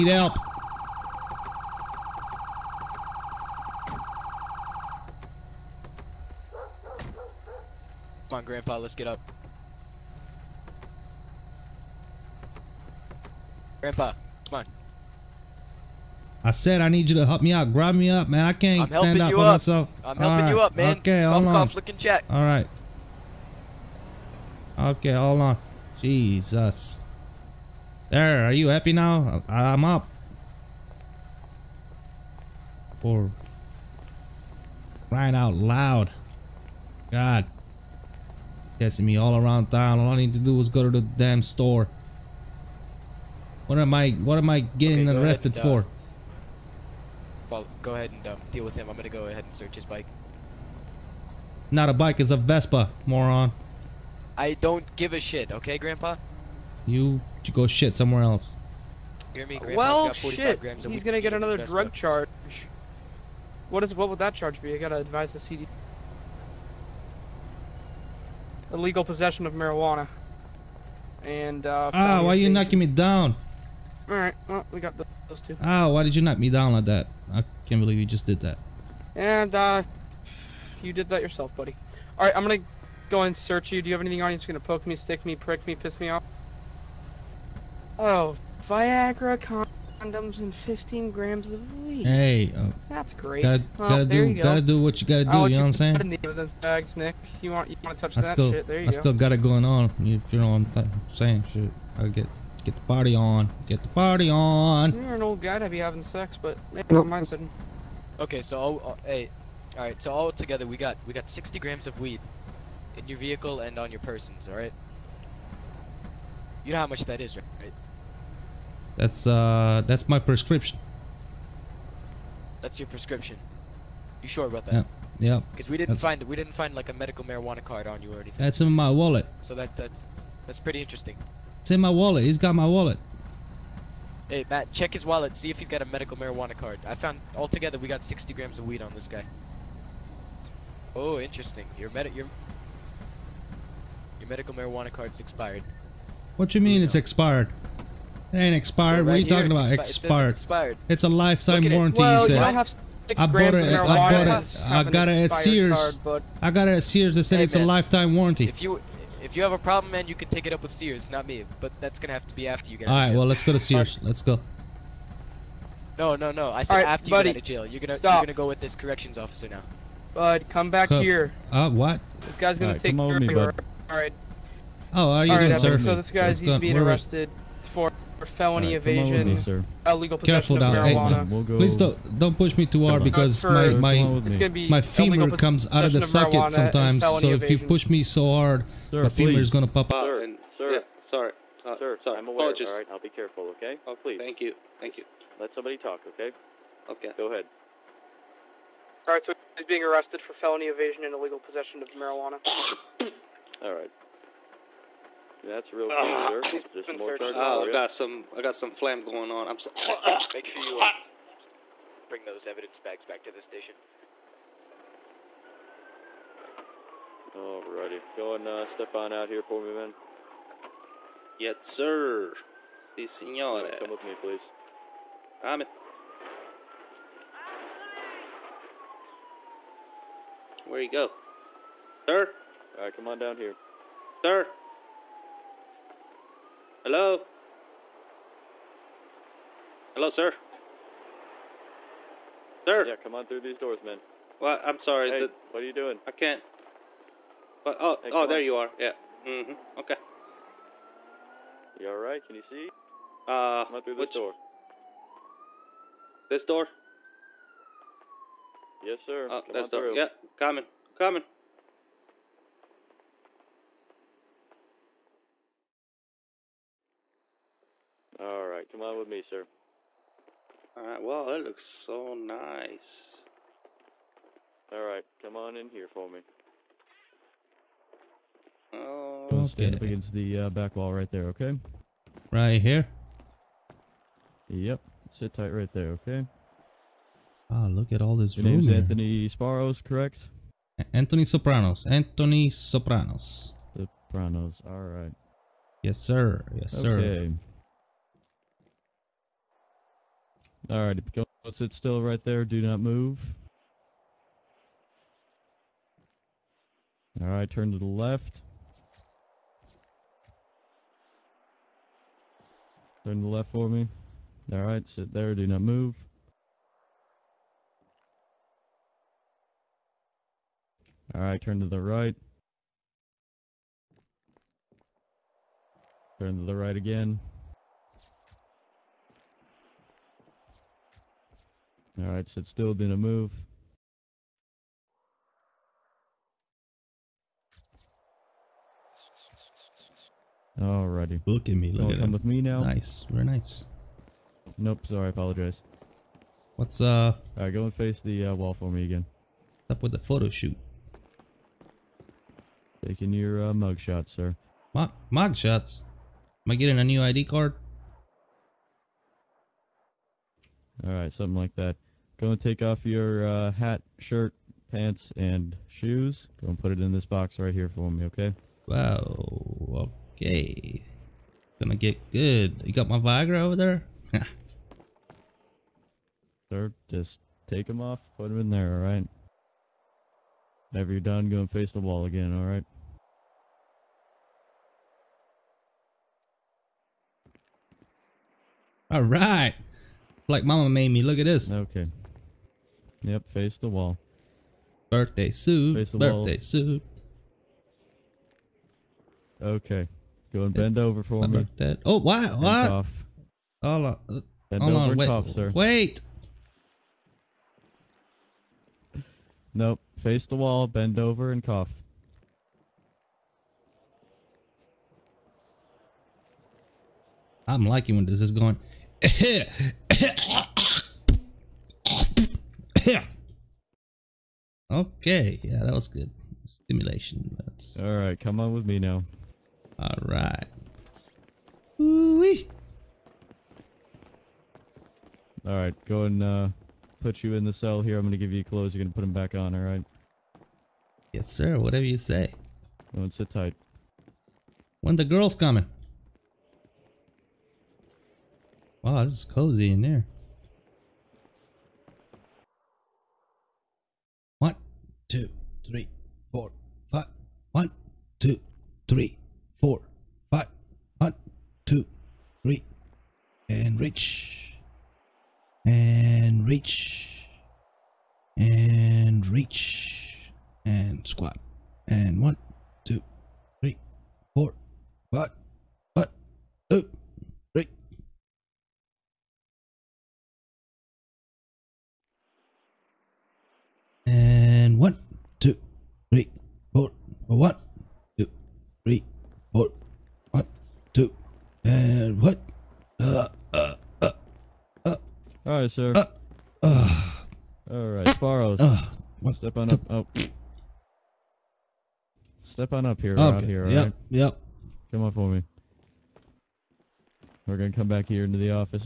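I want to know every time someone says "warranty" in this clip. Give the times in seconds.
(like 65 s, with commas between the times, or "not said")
151 s, 158 s.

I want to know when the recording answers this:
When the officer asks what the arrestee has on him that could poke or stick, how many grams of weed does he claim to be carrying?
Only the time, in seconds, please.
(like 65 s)
90 s.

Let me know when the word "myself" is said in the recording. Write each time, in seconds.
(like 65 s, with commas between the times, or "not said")
19 s.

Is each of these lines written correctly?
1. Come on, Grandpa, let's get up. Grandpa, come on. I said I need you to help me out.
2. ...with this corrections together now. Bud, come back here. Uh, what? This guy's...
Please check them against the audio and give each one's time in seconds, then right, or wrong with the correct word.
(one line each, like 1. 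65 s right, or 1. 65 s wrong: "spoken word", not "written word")
1. 8 s right
2. 168 s wrong: "officer", not "together".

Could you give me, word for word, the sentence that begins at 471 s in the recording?
And one, two, three, four, five.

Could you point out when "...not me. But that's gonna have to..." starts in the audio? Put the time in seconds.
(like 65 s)
161 s.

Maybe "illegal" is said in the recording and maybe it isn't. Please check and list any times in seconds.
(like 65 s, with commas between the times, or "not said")
68 s, 179 s, 201 s.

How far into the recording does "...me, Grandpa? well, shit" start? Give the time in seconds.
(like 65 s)
59 s.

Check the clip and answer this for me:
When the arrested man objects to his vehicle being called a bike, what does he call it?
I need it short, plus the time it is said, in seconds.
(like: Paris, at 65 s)
Vespa, at 52 s.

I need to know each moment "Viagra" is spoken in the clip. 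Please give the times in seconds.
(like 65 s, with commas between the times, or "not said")
88 s, 372 s.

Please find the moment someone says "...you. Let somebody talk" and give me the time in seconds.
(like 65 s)
194 s.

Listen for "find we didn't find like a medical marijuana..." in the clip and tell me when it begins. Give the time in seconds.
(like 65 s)
126 s.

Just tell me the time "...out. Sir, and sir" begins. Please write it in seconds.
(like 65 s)
189 s.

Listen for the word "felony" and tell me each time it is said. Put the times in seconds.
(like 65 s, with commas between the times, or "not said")
178 s, 200 s.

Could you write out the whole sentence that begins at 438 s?
You're gonna put them back on.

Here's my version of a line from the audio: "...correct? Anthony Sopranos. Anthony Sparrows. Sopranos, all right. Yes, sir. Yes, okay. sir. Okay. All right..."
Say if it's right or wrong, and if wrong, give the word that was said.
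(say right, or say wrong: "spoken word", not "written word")
wrong: "Sopranos", not "Sparrows".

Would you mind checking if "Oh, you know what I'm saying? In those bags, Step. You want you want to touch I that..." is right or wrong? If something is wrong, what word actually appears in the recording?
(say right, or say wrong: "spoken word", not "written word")
wrong: "Nick", not "Step".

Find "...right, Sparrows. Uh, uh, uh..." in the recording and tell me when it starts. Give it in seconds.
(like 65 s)
497 s.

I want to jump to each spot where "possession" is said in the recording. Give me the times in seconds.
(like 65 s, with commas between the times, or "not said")
69 s, 180 s, 201 s.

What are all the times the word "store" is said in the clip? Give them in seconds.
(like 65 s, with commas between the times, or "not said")
41 s.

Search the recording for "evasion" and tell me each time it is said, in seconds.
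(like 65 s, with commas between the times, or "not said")
178 s, 187 s, 200 s.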